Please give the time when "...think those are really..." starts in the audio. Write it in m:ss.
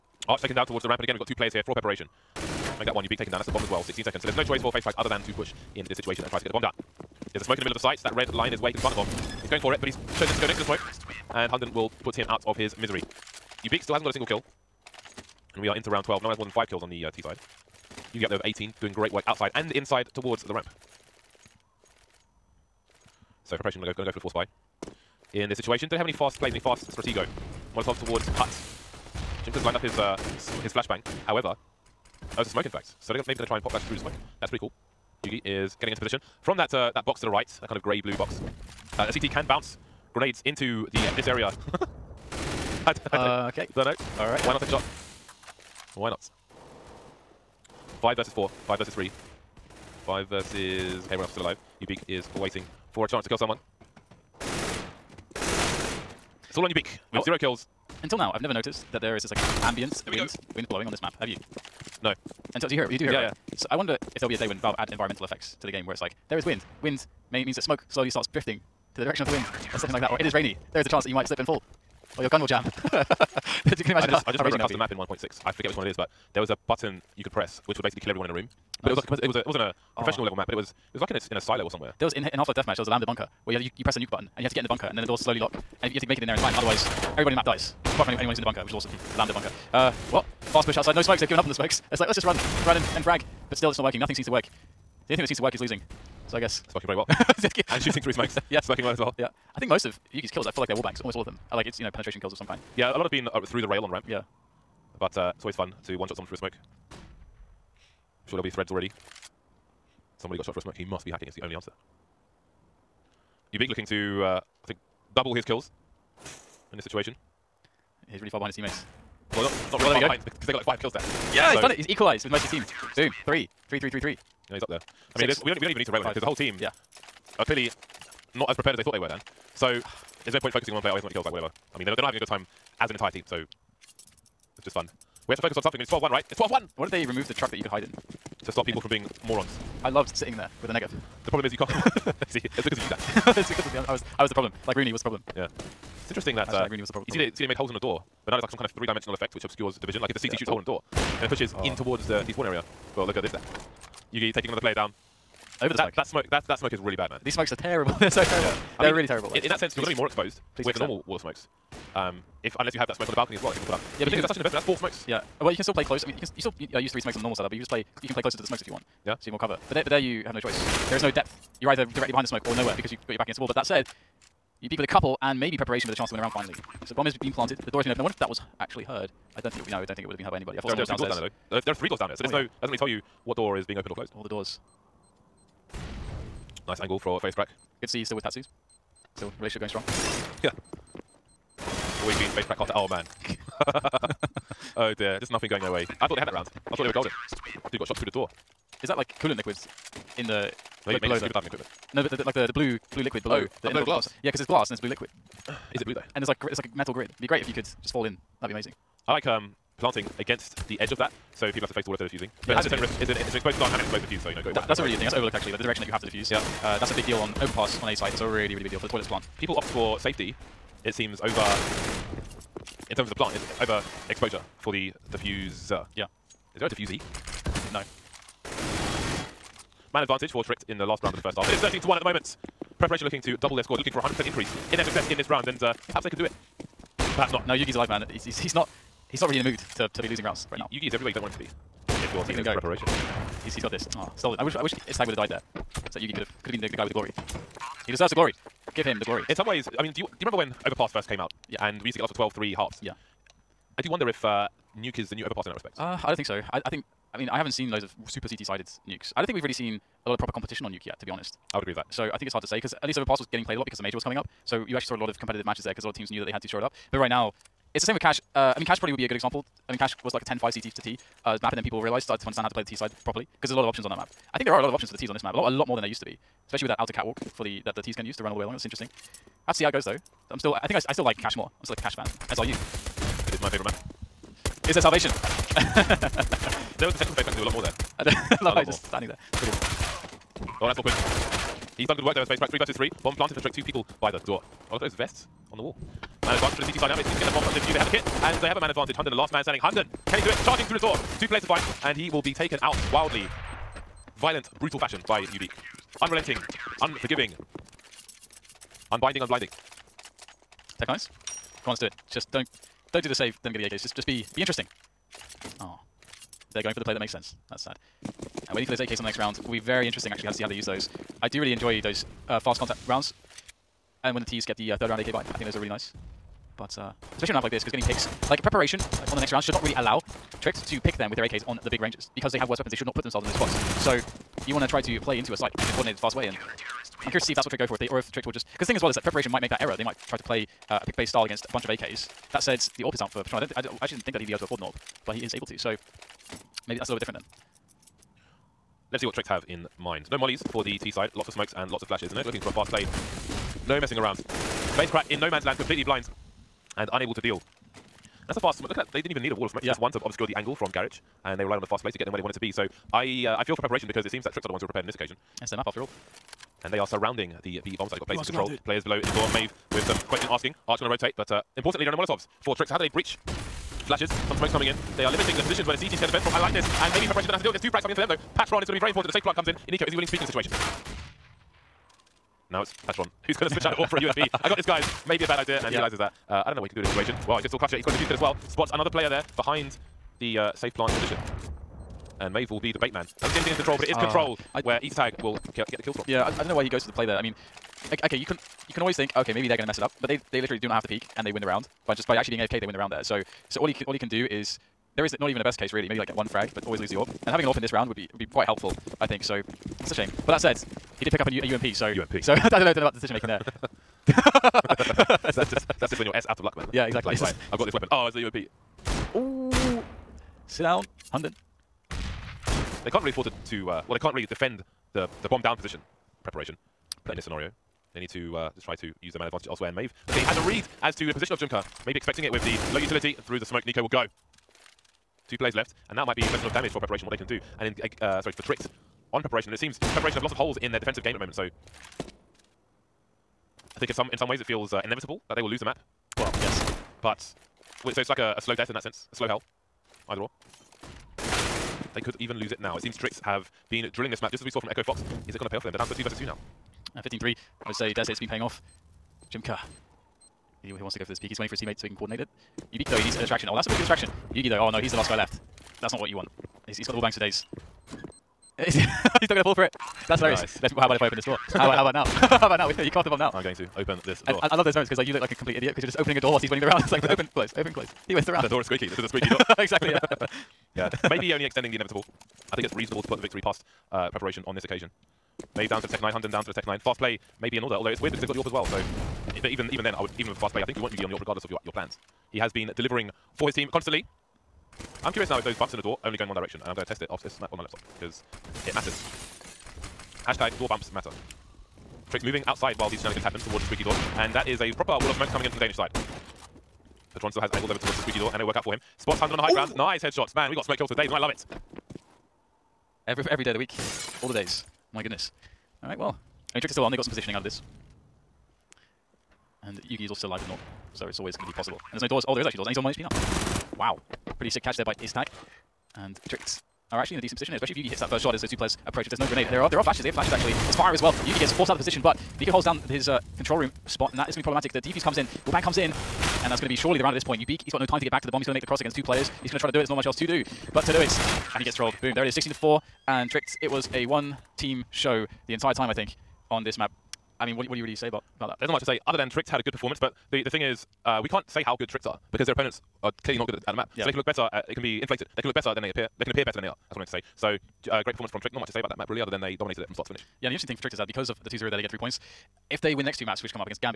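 5:25.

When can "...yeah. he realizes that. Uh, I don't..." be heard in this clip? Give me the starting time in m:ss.
6:25.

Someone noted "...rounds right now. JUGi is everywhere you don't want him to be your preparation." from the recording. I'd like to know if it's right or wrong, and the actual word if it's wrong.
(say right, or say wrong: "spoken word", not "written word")
right.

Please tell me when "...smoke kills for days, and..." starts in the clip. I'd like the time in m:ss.
8:30.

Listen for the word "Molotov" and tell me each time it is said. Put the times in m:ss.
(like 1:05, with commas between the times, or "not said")
0:27, 6:11.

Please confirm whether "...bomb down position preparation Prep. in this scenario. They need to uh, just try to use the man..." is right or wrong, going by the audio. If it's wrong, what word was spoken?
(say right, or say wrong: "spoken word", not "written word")
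right.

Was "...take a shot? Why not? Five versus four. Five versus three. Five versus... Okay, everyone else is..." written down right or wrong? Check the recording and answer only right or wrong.
right.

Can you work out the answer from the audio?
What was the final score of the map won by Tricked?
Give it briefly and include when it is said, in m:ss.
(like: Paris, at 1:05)
16 to 4, at 9:02.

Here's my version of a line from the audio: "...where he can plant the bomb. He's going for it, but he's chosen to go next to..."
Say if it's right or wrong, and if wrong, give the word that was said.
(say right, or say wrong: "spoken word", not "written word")
right.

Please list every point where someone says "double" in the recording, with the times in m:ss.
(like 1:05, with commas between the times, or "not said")
1:55, 3:53.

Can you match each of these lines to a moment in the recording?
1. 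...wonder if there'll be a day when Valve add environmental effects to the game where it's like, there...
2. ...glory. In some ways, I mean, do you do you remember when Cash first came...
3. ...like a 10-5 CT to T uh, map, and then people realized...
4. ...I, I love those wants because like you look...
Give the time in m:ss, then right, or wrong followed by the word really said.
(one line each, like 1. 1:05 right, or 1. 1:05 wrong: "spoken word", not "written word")
1. 1:03 right
2. 4:09 wrong: "Overpass", not "Cash"
3. 4:30 right
4. 7:54 wrong: "moments", not "wants".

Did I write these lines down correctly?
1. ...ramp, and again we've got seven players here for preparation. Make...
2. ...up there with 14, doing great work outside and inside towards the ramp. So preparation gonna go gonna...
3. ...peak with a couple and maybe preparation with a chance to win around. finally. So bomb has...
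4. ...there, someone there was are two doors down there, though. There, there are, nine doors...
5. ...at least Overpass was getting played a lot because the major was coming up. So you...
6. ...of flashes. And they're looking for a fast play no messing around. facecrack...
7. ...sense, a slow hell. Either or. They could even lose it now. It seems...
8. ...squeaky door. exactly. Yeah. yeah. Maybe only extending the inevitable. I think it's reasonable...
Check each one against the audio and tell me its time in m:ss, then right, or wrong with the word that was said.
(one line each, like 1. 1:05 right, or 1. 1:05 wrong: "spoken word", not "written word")
1. 0:00 wrong: "two", not "seven"
2. 0:18 wrong: "18", not "14"
3. 2:54 right
4. 3:00 wrong: "three", not "nine"
5. 4:22 right
6. 5:51 right
7. 7:28 right
8. 7:59 right.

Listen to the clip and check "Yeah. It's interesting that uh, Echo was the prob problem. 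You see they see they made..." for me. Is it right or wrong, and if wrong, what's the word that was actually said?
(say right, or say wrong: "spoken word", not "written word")
wrong: "Rooney", not "Echo".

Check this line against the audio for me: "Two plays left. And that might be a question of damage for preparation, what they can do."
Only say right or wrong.
right.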